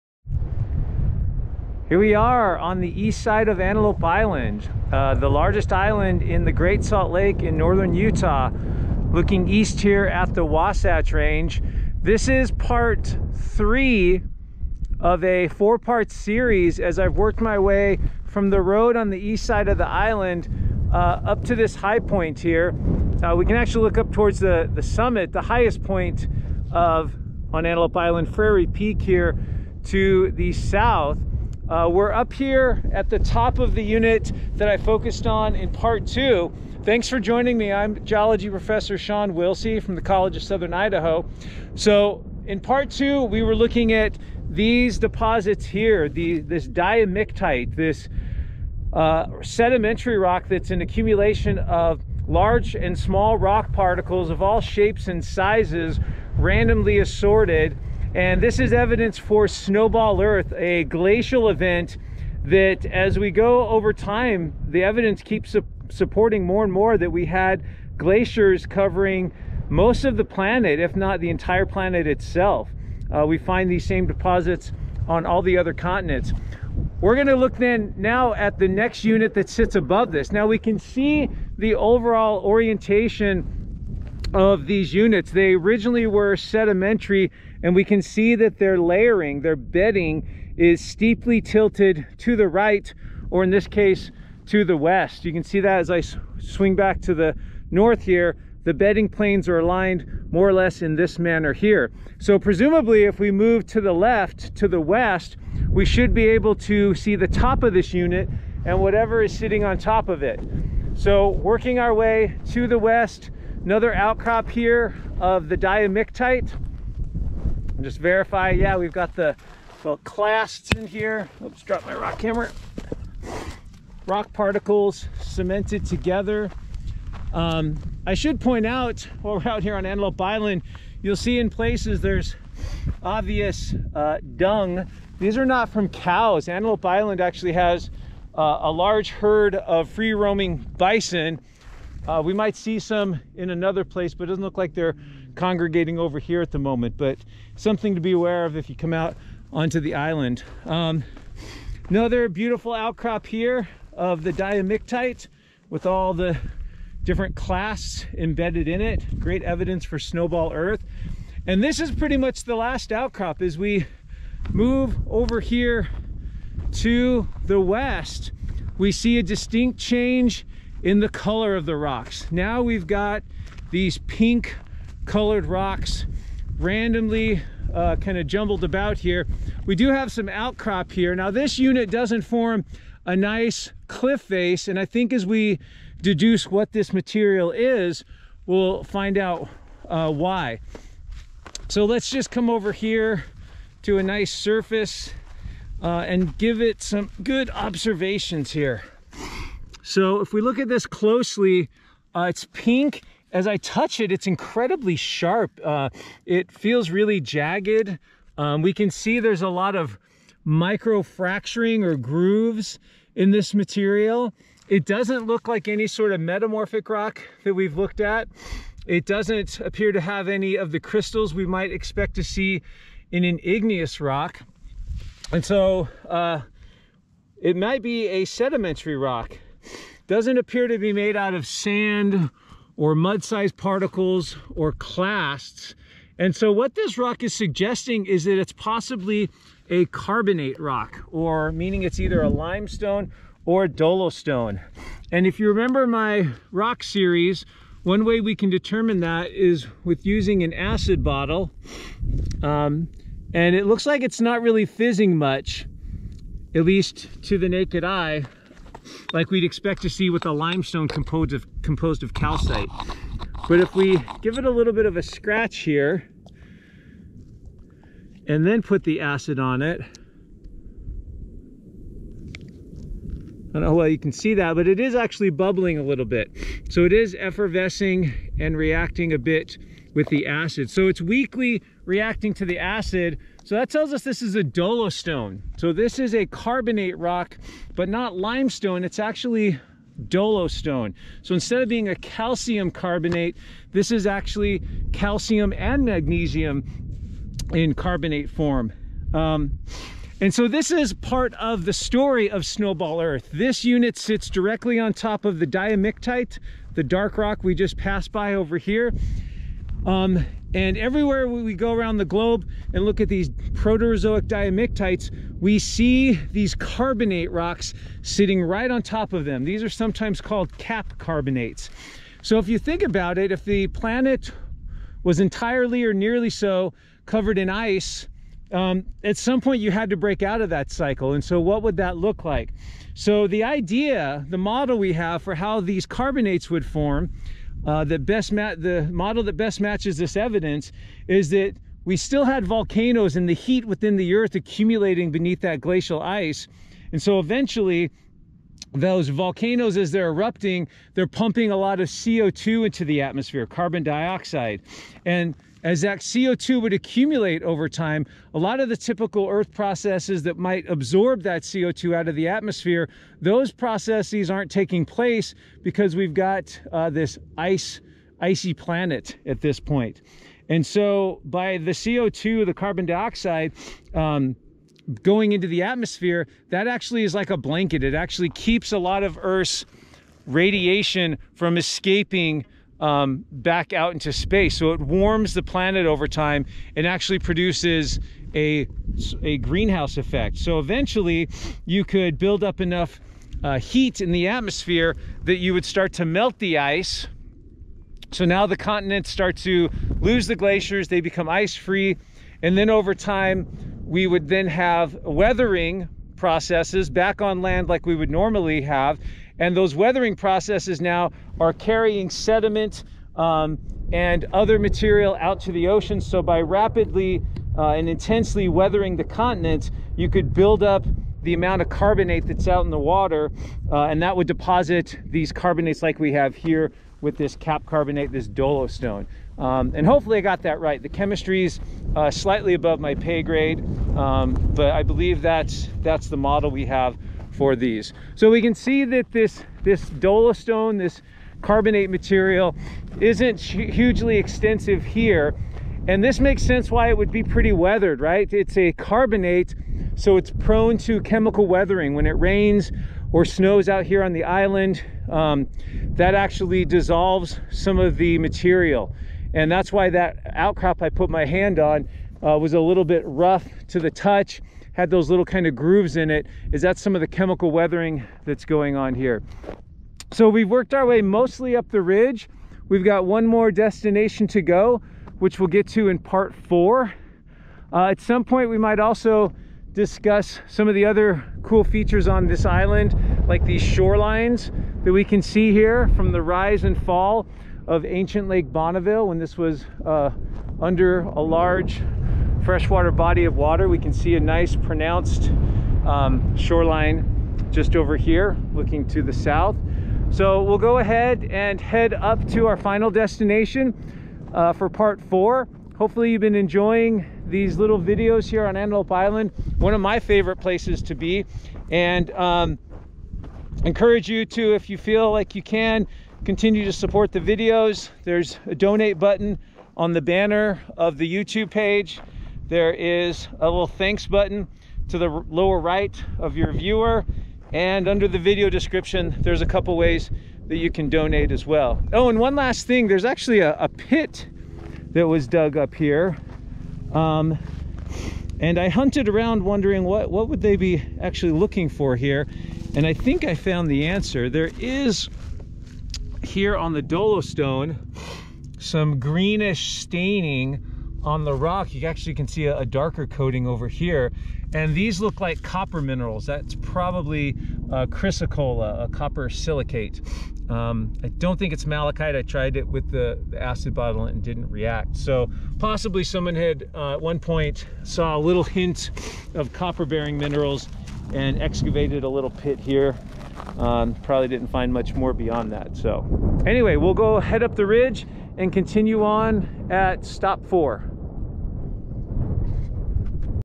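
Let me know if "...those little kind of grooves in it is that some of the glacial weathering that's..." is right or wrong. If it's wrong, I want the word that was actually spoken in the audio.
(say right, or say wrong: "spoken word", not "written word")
wrong: "chemical", not "glacial".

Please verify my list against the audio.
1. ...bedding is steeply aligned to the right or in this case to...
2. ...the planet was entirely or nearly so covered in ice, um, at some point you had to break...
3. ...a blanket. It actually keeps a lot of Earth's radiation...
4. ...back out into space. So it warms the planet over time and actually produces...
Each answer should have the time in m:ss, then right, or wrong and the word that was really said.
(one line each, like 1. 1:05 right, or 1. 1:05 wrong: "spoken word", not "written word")
1. 1:29 wrong: "tilted", not "aligned"
2. 5:23 right
3. 6:17 right
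4. 6:23 right.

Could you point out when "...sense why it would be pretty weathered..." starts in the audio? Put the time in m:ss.
7:26.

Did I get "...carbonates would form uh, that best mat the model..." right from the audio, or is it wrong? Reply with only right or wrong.
right.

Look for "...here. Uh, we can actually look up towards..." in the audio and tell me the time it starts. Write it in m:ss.
0:22.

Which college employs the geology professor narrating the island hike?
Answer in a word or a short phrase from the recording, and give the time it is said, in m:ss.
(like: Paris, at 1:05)
College of Southern Idaho, at 0:40.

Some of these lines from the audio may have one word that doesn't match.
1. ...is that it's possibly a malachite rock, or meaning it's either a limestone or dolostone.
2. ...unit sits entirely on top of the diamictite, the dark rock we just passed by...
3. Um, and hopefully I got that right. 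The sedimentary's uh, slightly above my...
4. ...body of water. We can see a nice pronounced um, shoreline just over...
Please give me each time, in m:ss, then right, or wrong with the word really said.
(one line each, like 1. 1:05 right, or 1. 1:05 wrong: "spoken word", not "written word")
1. 3:58 wrong: "carbonate", not "malachite"
2. 5:03 wrong: "directly", not "entirely"
3. 7:09 wrong: "chemistry", not "sedimentary"
4. 8:12 right.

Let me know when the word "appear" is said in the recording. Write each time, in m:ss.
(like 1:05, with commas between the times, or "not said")
3:39, 3:50.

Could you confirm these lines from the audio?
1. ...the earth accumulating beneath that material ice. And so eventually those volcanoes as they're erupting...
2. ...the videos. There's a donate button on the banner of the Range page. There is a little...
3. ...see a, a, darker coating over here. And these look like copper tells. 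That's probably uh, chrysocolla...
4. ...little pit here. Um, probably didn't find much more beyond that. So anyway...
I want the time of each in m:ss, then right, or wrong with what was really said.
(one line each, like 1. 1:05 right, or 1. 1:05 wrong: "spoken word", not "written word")
1. 5:43 wrong: "glacial", not "material"
2. 8:37 wrong: "YouTube", not "Range"
3. 9:12 wrong: "minerals", not "tells"
4. 9:32 right.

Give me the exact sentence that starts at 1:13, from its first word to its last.
Uh, we find these same deposits on all the other continents.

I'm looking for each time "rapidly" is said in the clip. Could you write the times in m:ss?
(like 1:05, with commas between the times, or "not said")
6:56.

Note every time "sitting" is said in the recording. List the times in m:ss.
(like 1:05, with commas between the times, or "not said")
1:49, 5:18.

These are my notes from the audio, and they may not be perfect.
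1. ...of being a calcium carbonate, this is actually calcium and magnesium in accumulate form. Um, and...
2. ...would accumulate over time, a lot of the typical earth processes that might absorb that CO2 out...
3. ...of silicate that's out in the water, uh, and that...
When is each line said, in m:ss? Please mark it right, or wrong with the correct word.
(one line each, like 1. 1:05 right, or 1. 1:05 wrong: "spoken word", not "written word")
1. 4:51 wrong: "carbonate", not "accumulate"
2. 5:56 right
3. 7:01 wrong: "carbonate", not "silicate".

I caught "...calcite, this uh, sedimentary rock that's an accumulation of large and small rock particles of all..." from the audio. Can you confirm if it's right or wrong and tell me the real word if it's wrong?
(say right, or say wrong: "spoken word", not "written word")
wrong: "diamictite", not "calcite".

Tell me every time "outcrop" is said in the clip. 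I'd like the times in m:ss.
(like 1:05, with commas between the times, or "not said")
1:53, 2:32, 2:42, 3:00, 7:40.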